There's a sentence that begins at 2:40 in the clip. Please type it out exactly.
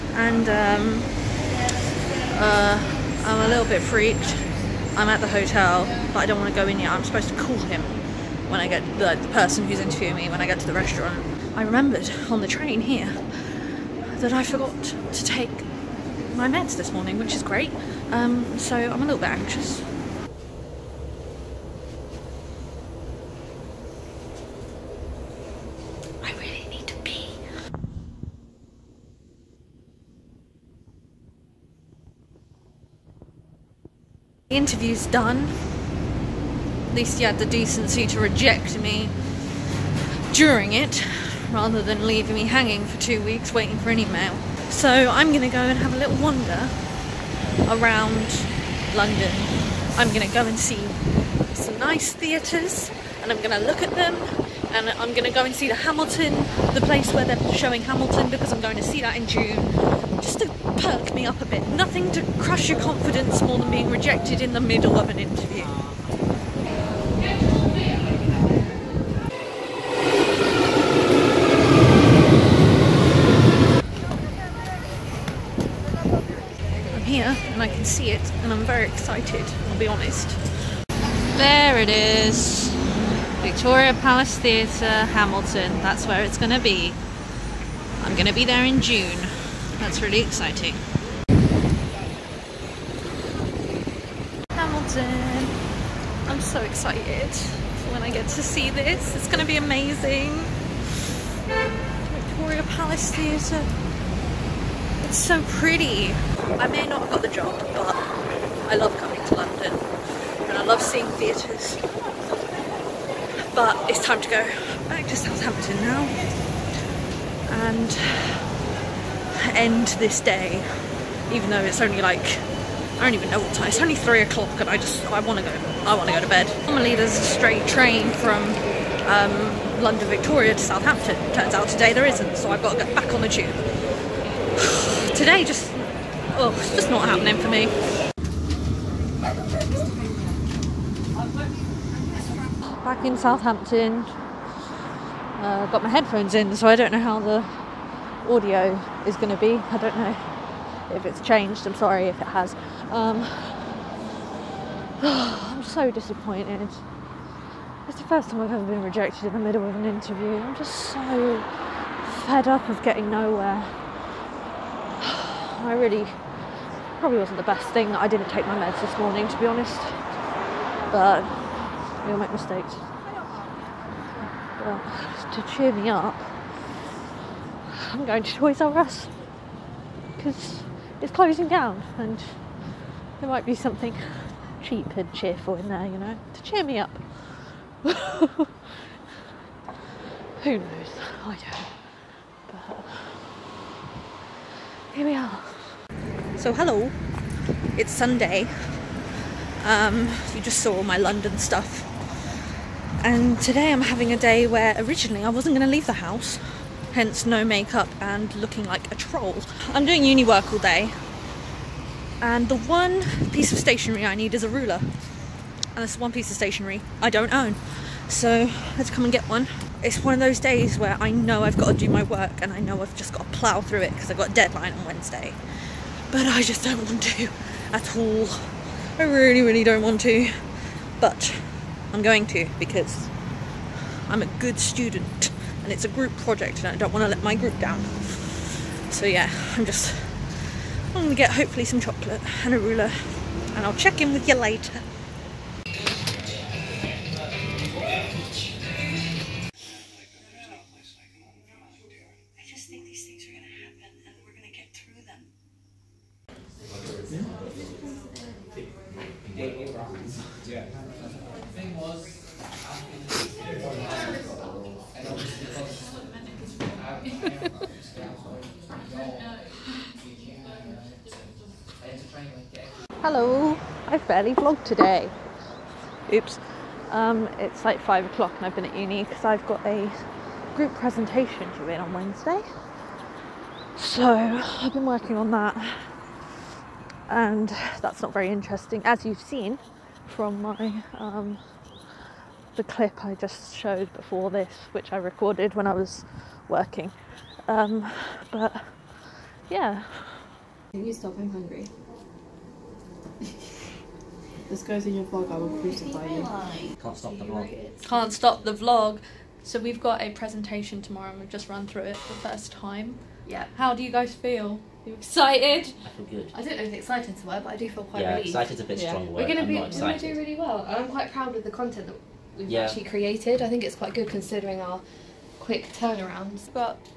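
I'm just so fed up of getting nowhere.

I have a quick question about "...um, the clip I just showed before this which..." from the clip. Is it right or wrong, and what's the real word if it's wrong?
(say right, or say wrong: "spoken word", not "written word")
right.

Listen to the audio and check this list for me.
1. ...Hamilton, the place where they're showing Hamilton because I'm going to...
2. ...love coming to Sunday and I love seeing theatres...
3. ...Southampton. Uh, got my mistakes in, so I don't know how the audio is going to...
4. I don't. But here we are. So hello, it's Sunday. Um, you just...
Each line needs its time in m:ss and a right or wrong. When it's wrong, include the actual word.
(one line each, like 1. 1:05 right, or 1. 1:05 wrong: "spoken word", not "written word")
1. 0:55 right
2. 1:48 wrong: "London", not "Sunday"
3. 2:23 wrong: "headphones", not "mistakes"
4. 3:11 right.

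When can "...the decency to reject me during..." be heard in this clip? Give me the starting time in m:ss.
0:37.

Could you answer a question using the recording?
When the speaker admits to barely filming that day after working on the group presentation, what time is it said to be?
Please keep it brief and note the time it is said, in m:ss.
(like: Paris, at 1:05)
5 o'clock, at 4:37.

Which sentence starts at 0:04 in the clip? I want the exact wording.
I'm at the hotel, but I don't want to go in yet.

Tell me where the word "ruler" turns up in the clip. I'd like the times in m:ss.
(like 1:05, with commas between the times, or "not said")
3:34, 4:02.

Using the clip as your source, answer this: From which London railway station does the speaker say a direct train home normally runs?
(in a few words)
London Victoria.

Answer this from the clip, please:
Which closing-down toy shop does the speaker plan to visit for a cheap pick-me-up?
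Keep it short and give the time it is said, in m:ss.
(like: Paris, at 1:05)
Toys R Us, at 2:58.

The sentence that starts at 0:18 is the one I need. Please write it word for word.
Um, so I'm a little bit anxious.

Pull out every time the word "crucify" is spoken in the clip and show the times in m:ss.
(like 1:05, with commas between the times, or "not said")
5:05.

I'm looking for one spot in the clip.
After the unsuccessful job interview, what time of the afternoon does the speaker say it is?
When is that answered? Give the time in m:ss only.
2:03.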